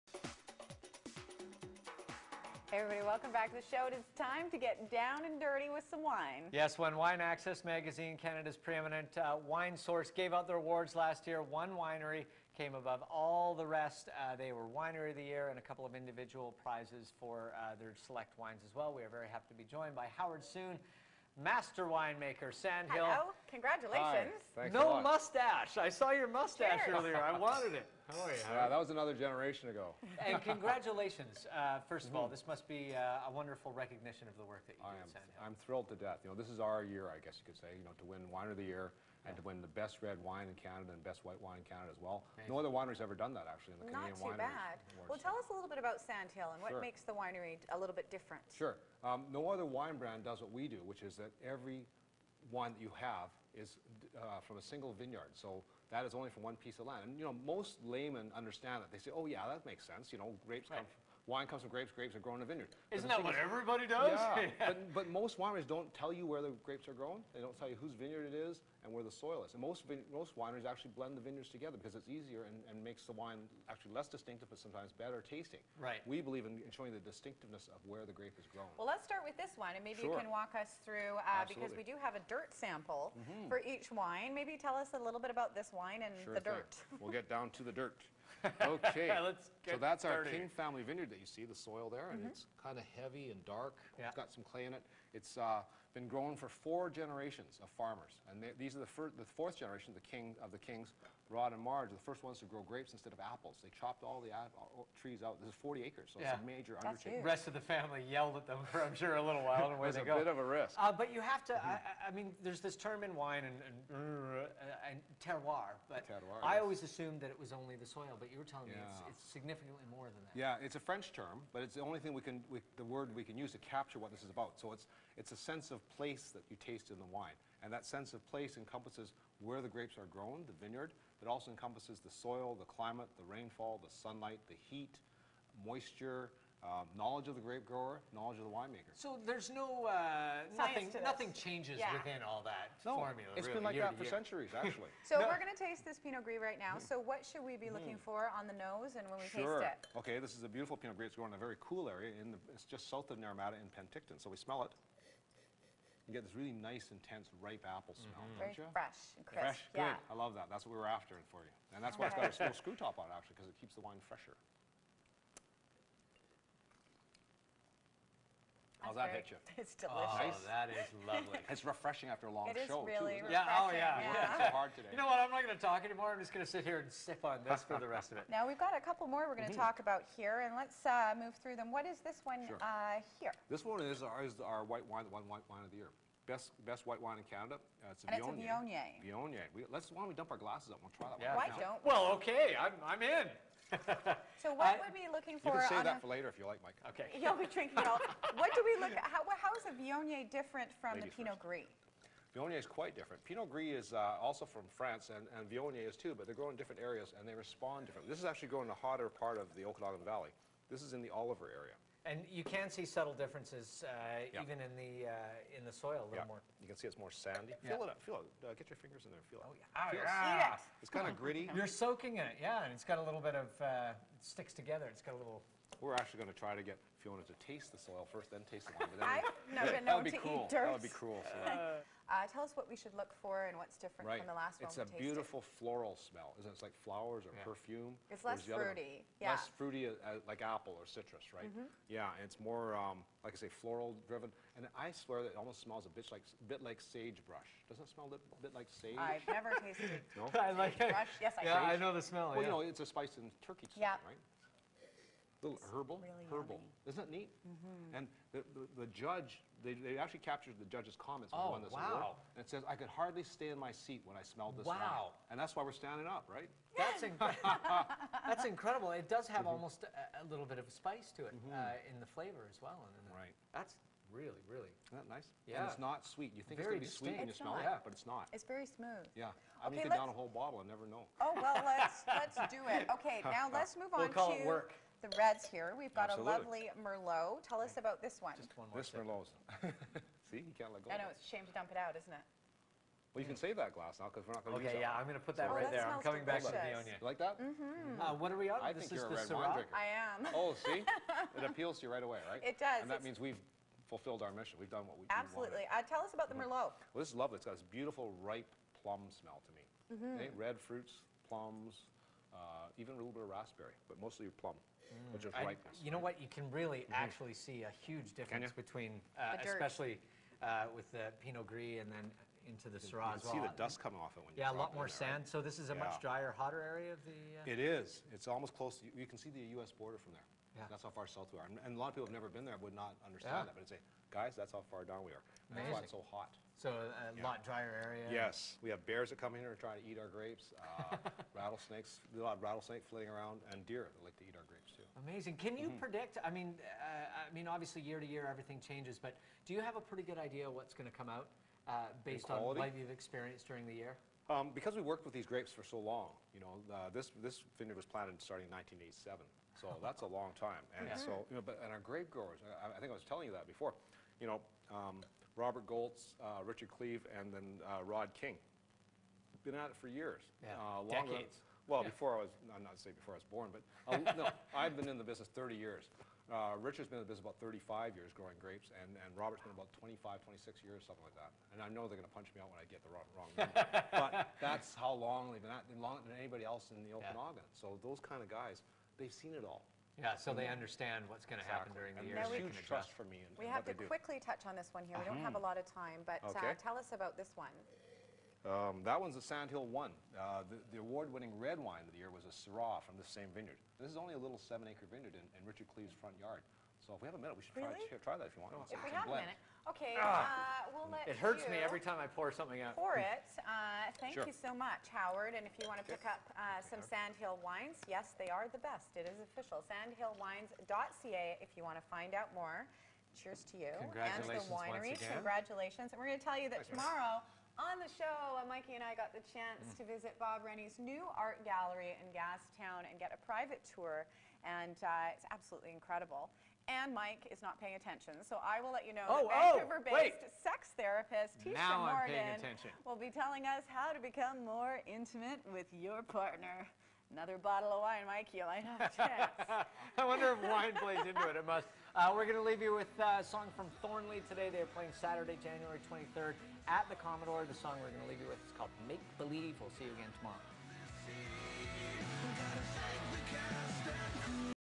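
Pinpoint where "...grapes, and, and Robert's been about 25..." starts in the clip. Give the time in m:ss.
6:18.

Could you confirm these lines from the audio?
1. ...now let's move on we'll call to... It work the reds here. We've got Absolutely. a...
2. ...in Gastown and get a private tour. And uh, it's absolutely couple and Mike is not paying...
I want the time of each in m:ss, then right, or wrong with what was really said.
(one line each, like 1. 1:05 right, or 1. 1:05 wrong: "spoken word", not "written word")
1. 4:43 right
2. 7:11 wrong: "incredible", not "couple".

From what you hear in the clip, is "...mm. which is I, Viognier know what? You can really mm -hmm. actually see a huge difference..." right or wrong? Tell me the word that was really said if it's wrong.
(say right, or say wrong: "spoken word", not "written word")
wrong: "You", not "Viognier".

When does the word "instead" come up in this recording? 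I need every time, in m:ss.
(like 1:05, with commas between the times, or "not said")
1:42.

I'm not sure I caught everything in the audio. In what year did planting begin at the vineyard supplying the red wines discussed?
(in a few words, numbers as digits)
1987.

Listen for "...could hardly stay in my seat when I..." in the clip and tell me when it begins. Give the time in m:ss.
4:22.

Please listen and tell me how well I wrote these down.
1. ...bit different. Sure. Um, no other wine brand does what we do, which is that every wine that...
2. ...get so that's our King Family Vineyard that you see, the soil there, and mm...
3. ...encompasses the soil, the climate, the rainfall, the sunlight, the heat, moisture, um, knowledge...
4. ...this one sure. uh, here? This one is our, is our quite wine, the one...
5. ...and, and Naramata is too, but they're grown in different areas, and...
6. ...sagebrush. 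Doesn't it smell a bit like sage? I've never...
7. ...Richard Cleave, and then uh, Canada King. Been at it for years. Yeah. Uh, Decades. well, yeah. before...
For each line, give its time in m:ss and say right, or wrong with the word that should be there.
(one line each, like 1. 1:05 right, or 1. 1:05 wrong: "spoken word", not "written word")
1. 0:47 right
2. 1:29 right
3. 2:11 right
4. 3:02 wrong: "white", not "quite"
5. 3:25 wrong: "Viognier", not "Naramata"
6. 4:06 right
7. 6:06 wrong: "Rod", not "Canada".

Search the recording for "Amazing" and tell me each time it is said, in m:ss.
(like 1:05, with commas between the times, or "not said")
5:35, 5:45.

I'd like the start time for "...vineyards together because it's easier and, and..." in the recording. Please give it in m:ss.
1:11.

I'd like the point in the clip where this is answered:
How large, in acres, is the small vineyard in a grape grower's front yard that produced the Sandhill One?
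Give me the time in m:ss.
6:44.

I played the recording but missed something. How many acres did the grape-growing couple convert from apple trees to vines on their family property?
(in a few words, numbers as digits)
40.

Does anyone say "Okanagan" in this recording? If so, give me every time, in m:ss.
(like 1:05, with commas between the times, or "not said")
3:29, 6:26.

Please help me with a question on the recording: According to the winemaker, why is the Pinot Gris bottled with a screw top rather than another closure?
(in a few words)
Keeps the wine fresher.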